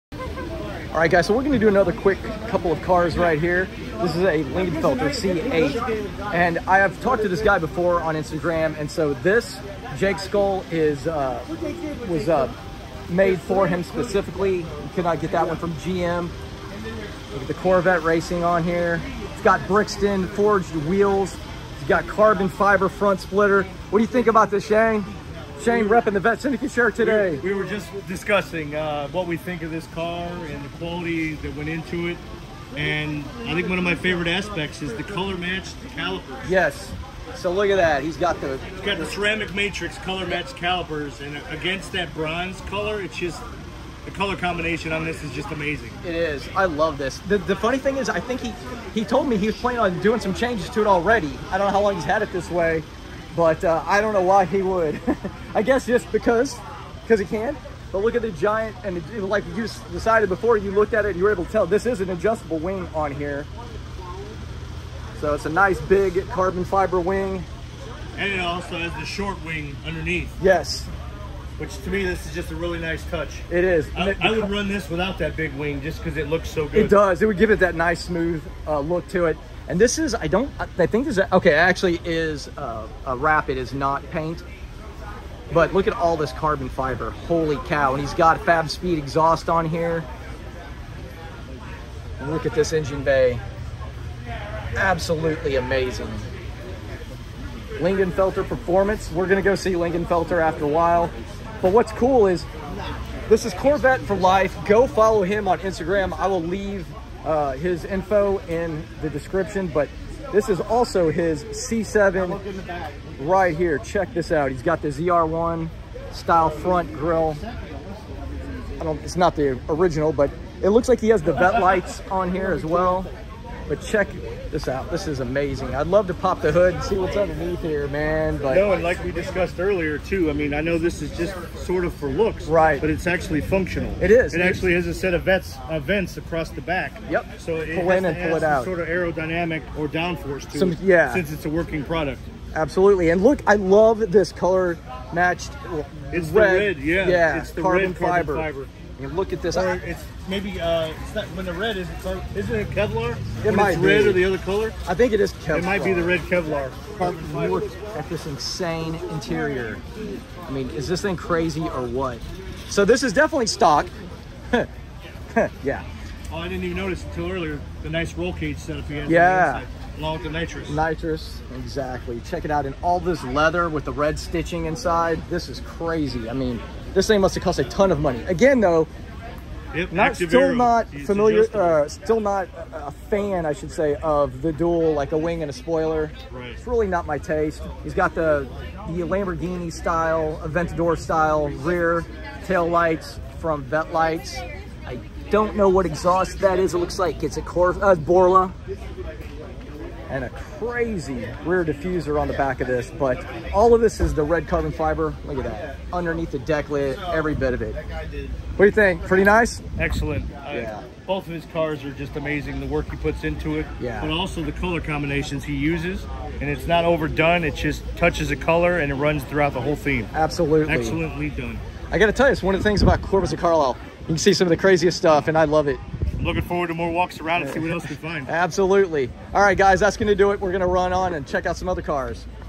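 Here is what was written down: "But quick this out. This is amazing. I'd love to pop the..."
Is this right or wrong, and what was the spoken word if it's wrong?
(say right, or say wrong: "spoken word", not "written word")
wrong: "check", not "quick".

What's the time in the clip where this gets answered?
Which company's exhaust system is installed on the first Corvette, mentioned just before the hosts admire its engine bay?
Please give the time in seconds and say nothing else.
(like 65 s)
88 s.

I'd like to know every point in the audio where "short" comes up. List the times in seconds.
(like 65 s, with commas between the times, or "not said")
69 s.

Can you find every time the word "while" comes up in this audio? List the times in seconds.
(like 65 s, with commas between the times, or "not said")
100 s.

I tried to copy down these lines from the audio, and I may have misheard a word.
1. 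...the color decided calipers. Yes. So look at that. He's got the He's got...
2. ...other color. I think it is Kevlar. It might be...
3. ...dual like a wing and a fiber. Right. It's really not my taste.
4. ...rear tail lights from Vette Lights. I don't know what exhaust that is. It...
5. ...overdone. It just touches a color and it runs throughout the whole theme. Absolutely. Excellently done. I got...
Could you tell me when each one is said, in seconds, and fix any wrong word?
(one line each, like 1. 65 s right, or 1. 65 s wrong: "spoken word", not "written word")
1. 34 s wrong: "matched", not "decided"
2. 154 s right
3. 184 s wrong: "spoiler", not "fiber"
4. 191 s right
5. 216 s right.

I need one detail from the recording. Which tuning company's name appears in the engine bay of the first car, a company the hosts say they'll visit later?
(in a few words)
Lingenfelter Performance.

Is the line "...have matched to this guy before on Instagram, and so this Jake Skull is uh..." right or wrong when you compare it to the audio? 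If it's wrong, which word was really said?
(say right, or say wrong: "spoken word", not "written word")
wrong: "talked", not "matched".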